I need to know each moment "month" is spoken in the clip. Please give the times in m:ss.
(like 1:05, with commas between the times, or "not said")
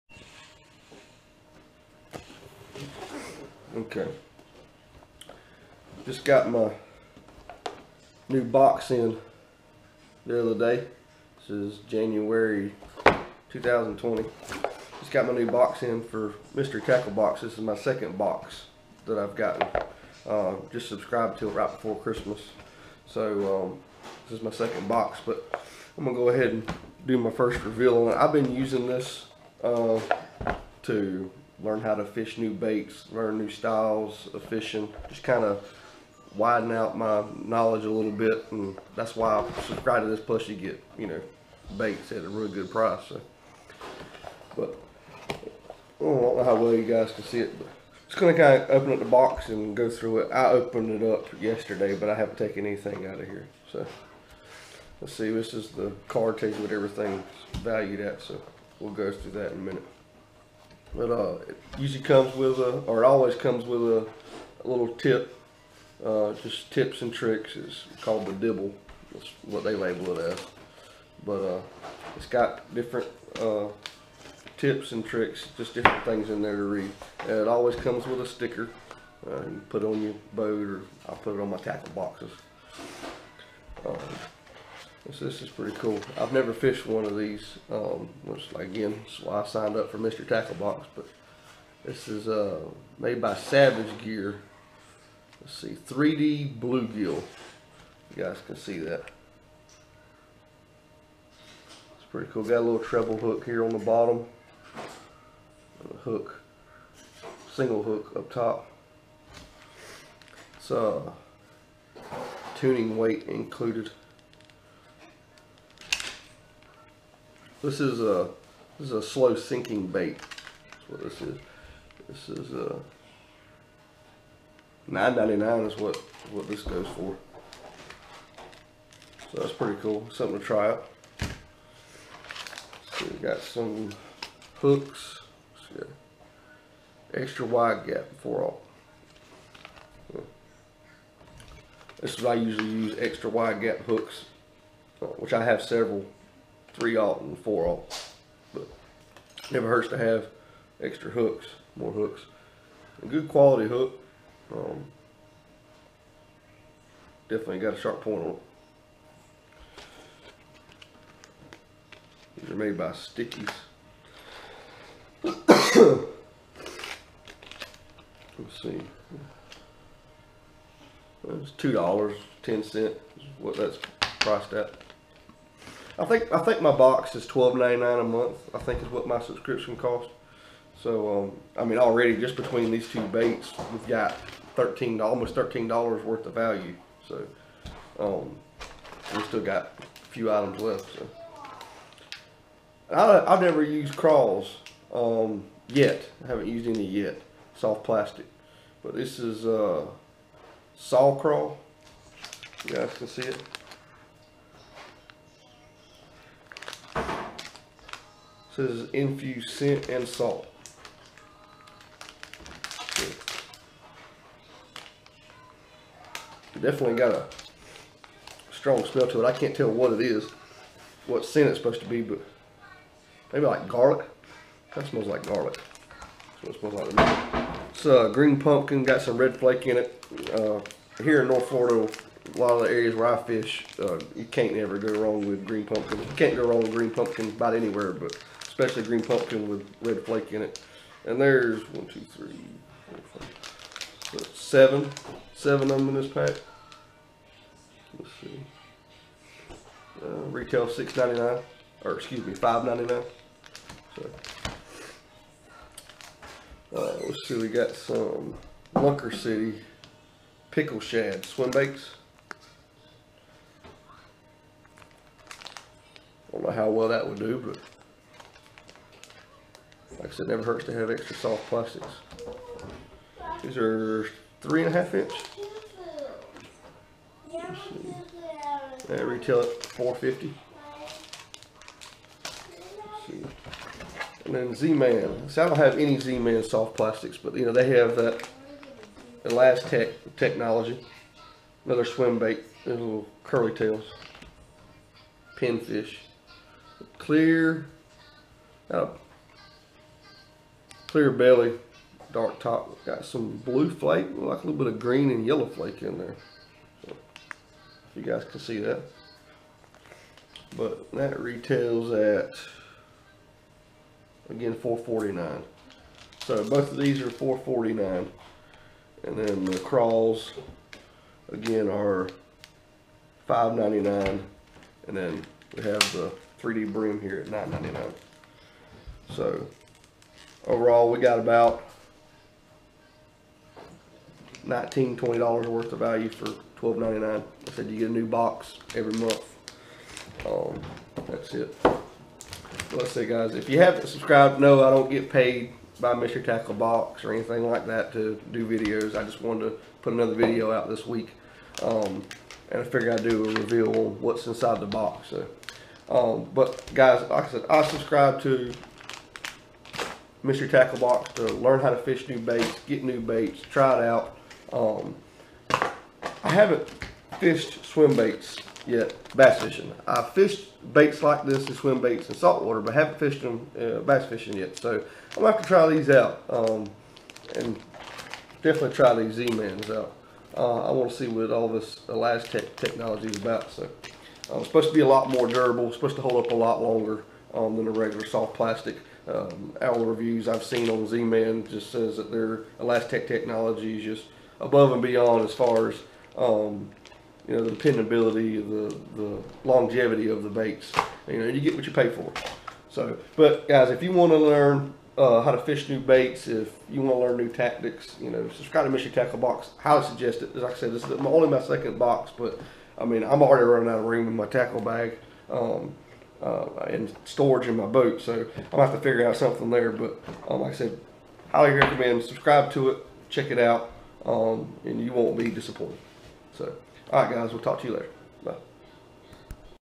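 2:58, 5:38.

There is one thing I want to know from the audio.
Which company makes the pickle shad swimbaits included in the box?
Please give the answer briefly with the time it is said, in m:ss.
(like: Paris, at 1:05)
Lunker City, at 4:18.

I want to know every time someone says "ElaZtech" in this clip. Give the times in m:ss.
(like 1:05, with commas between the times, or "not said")
4:49, 6:21, 6:32.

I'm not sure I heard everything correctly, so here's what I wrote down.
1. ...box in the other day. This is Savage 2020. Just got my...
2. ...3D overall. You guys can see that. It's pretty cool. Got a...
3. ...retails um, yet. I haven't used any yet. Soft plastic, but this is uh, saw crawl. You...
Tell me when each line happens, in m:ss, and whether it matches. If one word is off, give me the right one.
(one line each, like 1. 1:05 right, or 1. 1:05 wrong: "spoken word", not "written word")
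1. 0:08 wrong: "January", not "Savage"
2. 1:35 wrong: "bluegill", not "overall"
3. 3:13 wrong: "crawls", not "retails".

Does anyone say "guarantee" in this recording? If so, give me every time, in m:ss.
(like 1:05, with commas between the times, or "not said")
not said.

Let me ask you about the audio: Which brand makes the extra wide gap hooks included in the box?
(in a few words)
Stickies.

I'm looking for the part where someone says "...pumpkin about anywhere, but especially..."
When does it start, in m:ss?
3:56.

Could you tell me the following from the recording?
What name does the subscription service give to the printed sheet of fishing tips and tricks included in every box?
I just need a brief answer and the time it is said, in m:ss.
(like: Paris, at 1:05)
the dibble, at 1:08.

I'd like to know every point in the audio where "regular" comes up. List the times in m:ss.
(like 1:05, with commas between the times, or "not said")
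6:27.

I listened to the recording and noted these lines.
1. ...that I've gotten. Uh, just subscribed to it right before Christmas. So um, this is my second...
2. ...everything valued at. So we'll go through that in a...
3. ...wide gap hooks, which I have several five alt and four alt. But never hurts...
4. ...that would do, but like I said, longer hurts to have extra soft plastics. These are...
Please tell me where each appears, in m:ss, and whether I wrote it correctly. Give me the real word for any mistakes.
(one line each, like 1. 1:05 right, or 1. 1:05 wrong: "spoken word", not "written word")
1. 0:19 right
2. 0:56 right
3. 2:23 wrong: "three", not "five"
4. 4:26 wrong: "never", not "longer".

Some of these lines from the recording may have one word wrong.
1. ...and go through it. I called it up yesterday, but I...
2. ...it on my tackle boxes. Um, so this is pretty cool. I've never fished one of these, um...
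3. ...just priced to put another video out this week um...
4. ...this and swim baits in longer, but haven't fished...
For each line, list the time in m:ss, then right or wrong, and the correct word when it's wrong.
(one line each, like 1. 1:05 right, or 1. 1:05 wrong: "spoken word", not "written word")
1. 0:49 wrong: "opened", not "called"
2. 1:21 right
3. 5:49 wrong: "wanted", not "priced"
4. 6:11 wrong: "saltwater", not "longer".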